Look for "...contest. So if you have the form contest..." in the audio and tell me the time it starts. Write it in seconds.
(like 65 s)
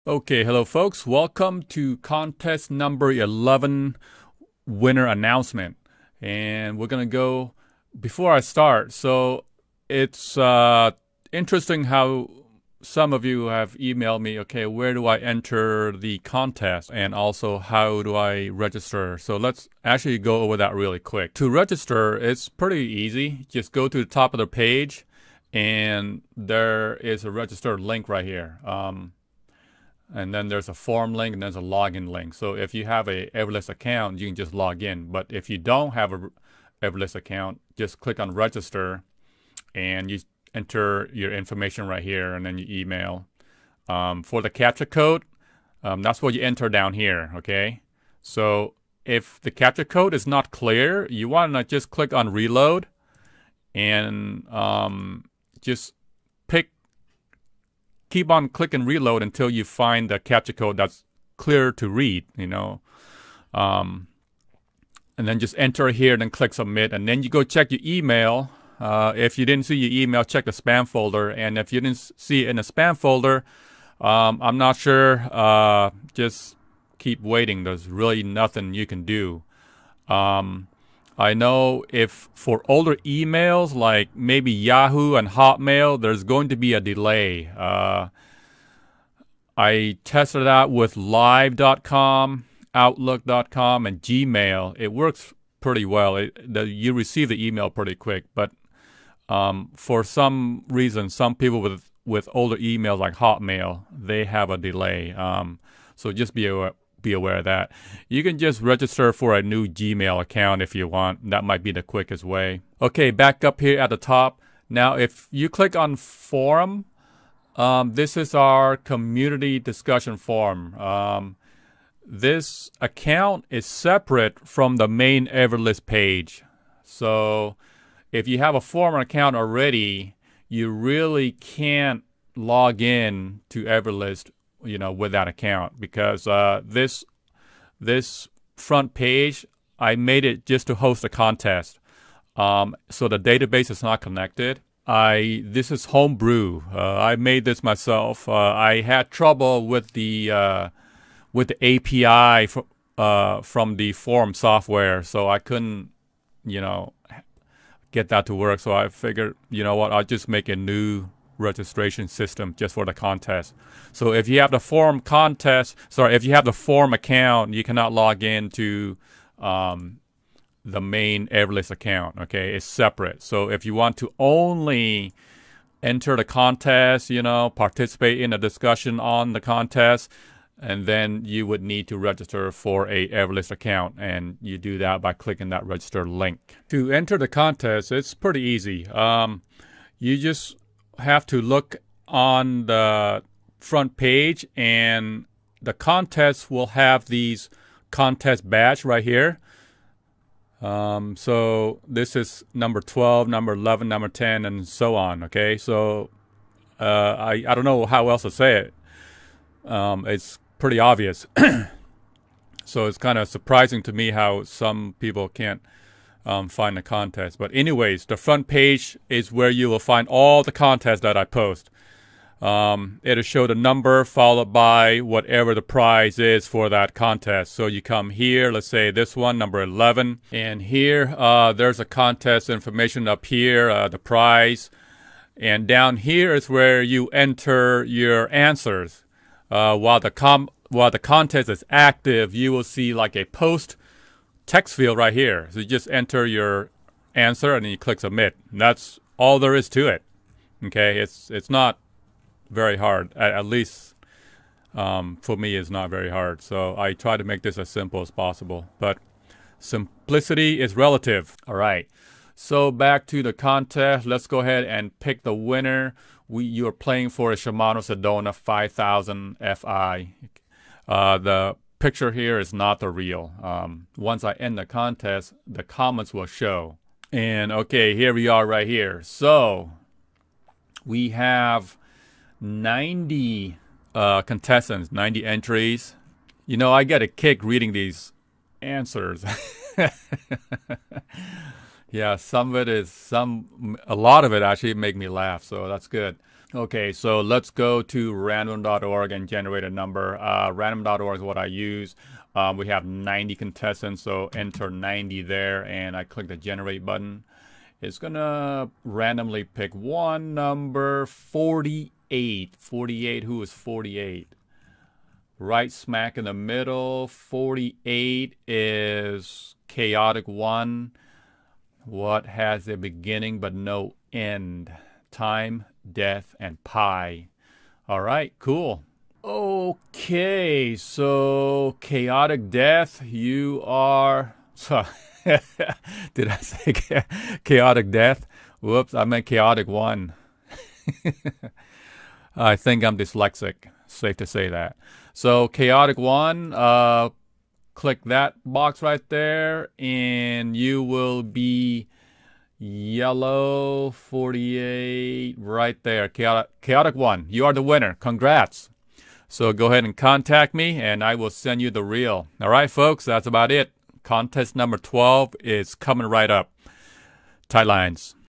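162 s.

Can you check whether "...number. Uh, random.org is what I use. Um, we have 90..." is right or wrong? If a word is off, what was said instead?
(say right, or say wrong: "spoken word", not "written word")
right.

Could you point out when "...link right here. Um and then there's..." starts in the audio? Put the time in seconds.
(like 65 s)
27 s.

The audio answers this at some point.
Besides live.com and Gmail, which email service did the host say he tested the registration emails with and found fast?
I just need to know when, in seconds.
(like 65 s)
92 s.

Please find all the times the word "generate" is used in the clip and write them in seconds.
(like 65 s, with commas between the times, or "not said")
299 s, 306 s.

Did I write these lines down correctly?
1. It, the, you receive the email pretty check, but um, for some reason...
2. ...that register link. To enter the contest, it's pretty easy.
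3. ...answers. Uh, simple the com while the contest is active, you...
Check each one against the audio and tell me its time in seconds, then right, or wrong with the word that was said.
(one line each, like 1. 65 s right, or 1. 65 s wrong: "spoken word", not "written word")
1. 96 s wrong: "quick", not "check"
2. 185 s right
3. 238 s wrong: "while", not "simple".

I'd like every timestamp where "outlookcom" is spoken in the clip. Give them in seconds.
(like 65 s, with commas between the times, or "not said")
92 s.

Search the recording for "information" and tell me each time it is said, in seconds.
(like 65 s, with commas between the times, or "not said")
41 s, 232 s.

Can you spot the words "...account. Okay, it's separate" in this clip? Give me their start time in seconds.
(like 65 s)
171 s.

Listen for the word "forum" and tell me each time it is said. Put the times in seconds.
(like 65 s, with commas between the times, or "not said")
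115 s, 120 s, 128 s, 153 s.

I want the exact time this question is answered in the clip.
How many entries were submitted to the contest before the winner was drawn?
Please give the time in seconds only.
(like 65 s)
284 s.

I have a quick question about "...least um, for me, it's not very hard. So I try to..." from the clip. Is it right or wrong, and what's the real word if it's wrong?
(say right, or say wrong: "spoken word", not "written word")
right.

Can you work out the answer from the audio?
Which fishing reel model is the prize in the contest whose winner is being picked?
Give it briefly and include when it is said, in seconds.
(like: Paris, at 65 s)
Shimano Sedona 5000 Fi, at 267 s.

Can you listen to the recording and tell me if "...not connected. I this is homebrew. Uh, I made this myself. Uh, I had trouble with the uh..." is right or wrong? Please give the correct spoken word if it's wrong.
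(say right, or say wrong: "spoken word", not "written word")
right.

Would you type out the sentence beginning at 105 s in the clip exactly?
Um, so just be aware, be aware of that.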